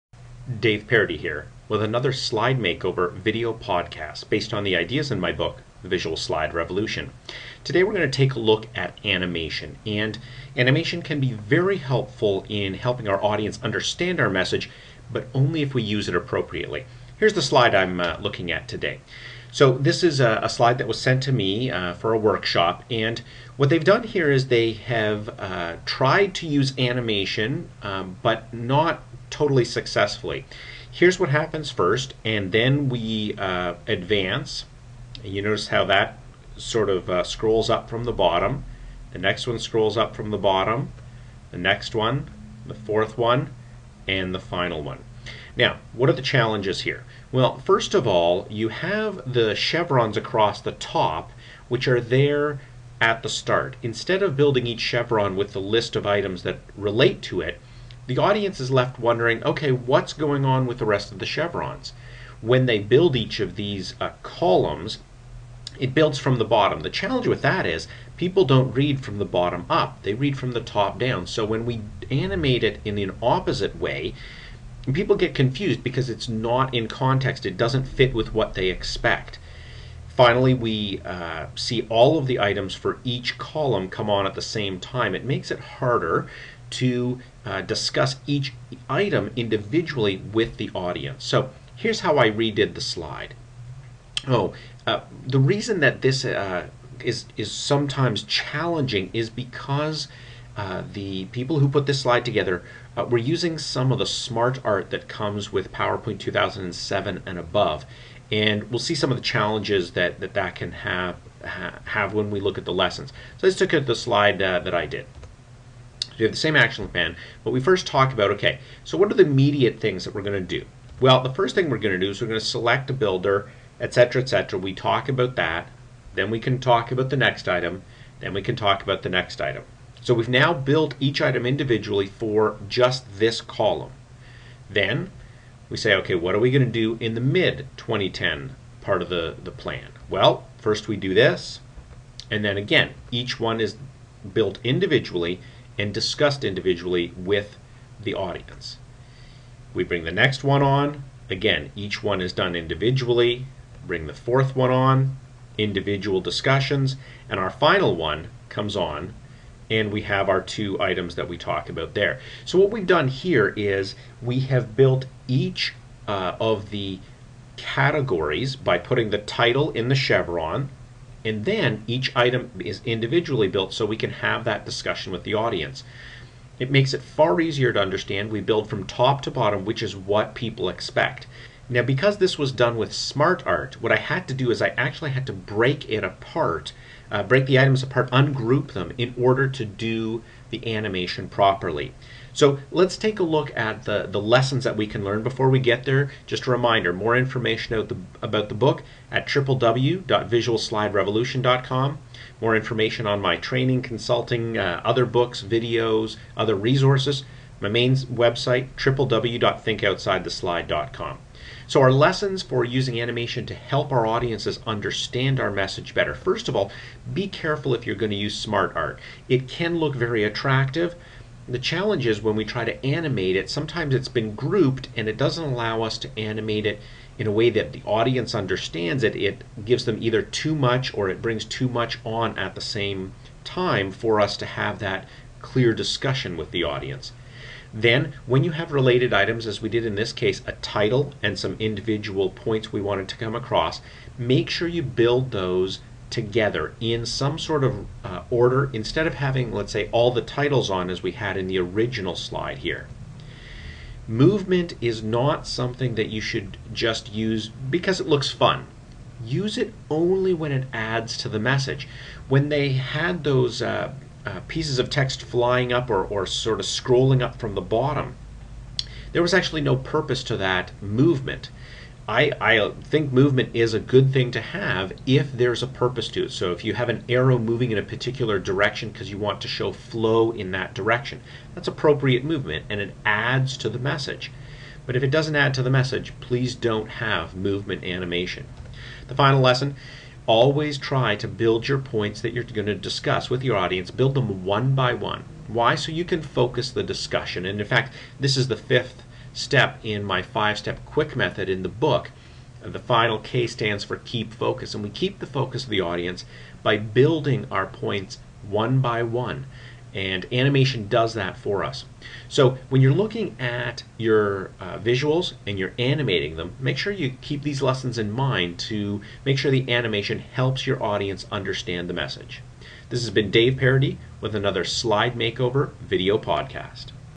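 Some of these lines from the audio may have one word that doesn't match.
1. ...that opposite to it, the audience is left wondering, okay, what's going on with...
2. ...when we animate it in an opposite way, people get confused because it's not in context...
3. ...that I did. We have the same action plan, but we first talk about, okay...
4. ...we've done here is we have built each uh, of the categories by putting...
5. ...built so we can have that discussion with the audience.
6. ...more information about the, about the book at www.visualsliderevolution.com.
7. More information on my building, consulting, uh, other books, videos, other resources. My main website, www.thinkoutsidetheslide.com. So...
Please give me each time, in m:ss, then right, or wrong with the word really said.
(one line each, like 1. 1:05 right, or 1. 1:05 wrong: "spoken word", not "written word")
1. 0:56 wrong: "relate", not "opposite"
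2. 1:11 right
3. 1:54 right
4. 2:42 right
5. 2:53 right
6. 3:16 right
7. 3:22 wrong: "training", not "building".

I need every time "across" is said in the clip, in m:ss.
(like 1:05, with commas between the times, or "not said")
0:50, 4:03.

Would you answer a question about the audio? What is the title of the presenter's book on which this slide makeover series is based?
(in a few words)
The Visual Slide Revolution.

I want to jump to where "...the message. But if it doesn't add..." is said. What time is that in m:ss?
4:43.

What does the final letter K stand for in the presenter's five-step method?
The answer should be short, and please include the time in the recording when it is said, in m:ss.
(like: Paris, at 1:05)
Keep focus, at 5:03.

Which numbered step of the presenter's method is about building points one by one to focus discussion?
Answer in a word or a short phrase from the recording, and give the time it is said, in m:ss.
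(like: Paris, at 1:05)
5th, at 4:58.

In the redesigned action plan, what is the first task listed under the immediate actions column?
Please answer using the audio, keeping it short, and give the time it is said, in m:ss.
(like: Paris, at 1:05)
Select a builder, at 2:02.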